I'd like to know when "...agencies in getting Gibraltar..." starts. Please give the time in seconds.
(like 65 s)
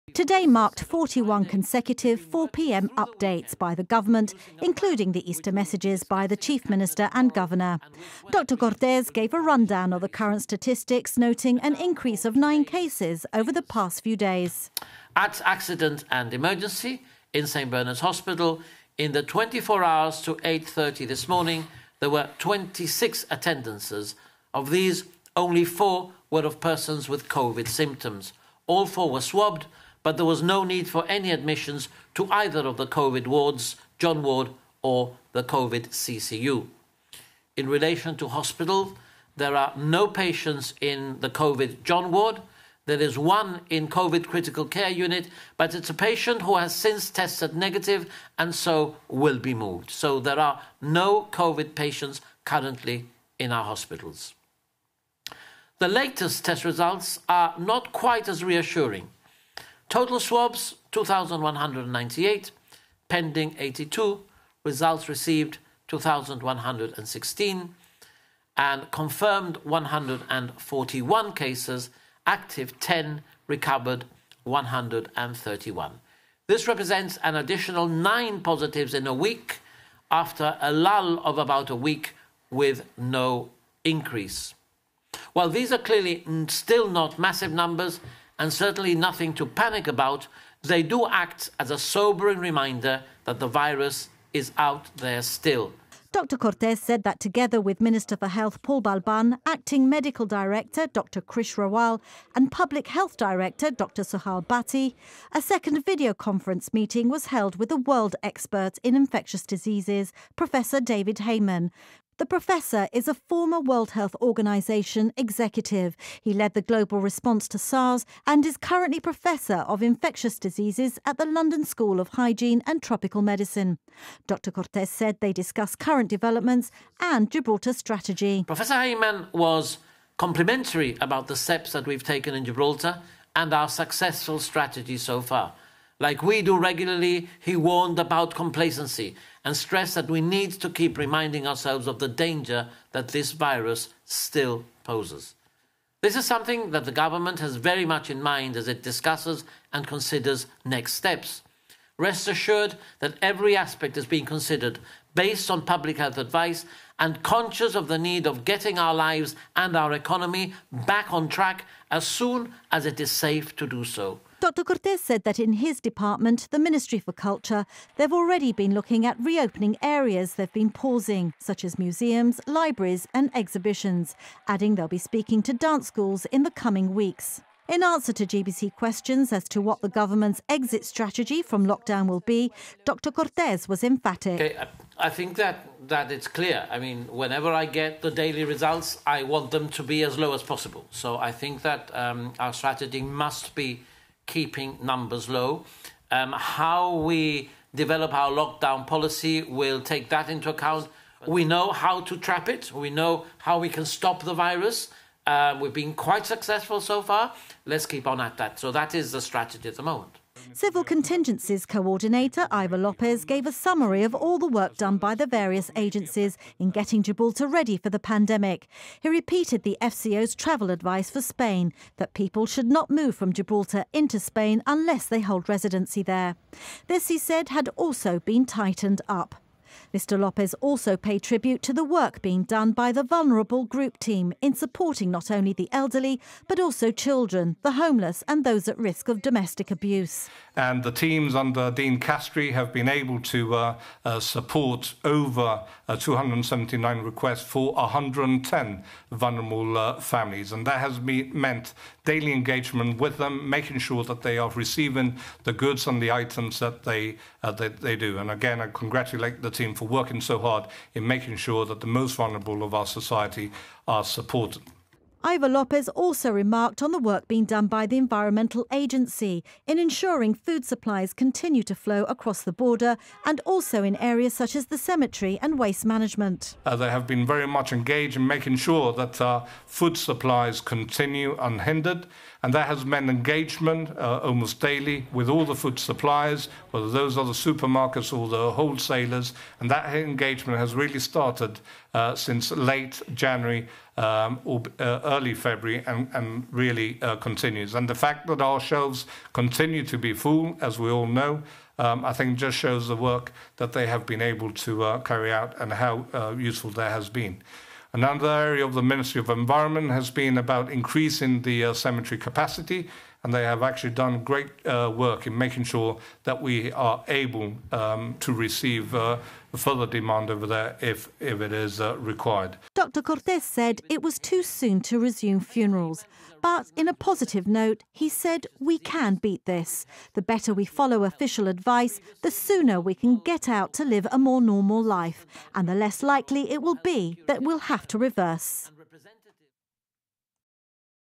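215 s.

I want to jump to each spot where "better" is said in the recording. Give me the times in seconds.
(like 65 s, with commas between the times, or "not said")
330 s.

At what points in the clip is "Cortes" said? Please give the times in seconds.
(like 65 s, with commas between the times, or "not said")
8 s, 96 s, 124 s, 164 s, 183 s, 323 s.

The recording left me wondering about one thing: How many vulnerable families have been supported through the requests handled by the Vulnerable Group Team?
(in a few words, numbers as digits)
110.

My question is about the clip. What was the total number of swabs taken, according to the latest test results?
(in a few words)
2,198.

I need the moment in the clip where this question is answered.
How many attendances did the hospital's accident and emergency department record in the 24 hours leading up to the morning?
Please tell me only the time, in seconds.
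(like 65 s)
22 s.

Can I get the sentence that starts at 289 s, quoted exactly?
And that engagement has really started uh, since late January um, or uh, early February and, and really uh, continues.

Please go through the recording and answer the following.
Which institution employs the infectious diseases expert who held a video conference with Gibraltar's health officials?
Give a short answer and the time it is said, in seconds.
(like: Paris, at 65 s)
London School of Hygiene and Tropical Medicine, at 121 s.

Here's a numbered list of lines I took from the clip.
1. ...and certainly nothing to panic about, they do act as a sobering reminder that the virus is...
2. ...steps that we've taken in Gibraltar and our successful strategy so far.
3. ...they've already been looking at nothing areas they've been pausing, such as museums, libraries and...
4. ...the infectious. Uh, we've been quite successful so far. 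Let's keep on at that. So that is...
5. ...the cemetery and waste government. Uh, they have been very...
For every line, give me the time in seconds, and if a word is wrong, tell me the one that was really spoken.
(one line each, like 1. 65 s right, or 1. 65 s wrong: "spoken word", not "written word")
1. 88 s right
2. 131 s right
3. 167 s wrong: "reopening", not "nothing"
4. 204 s wrong: "virus", not "infectious"
5. 274 s wrong: "management", not "government".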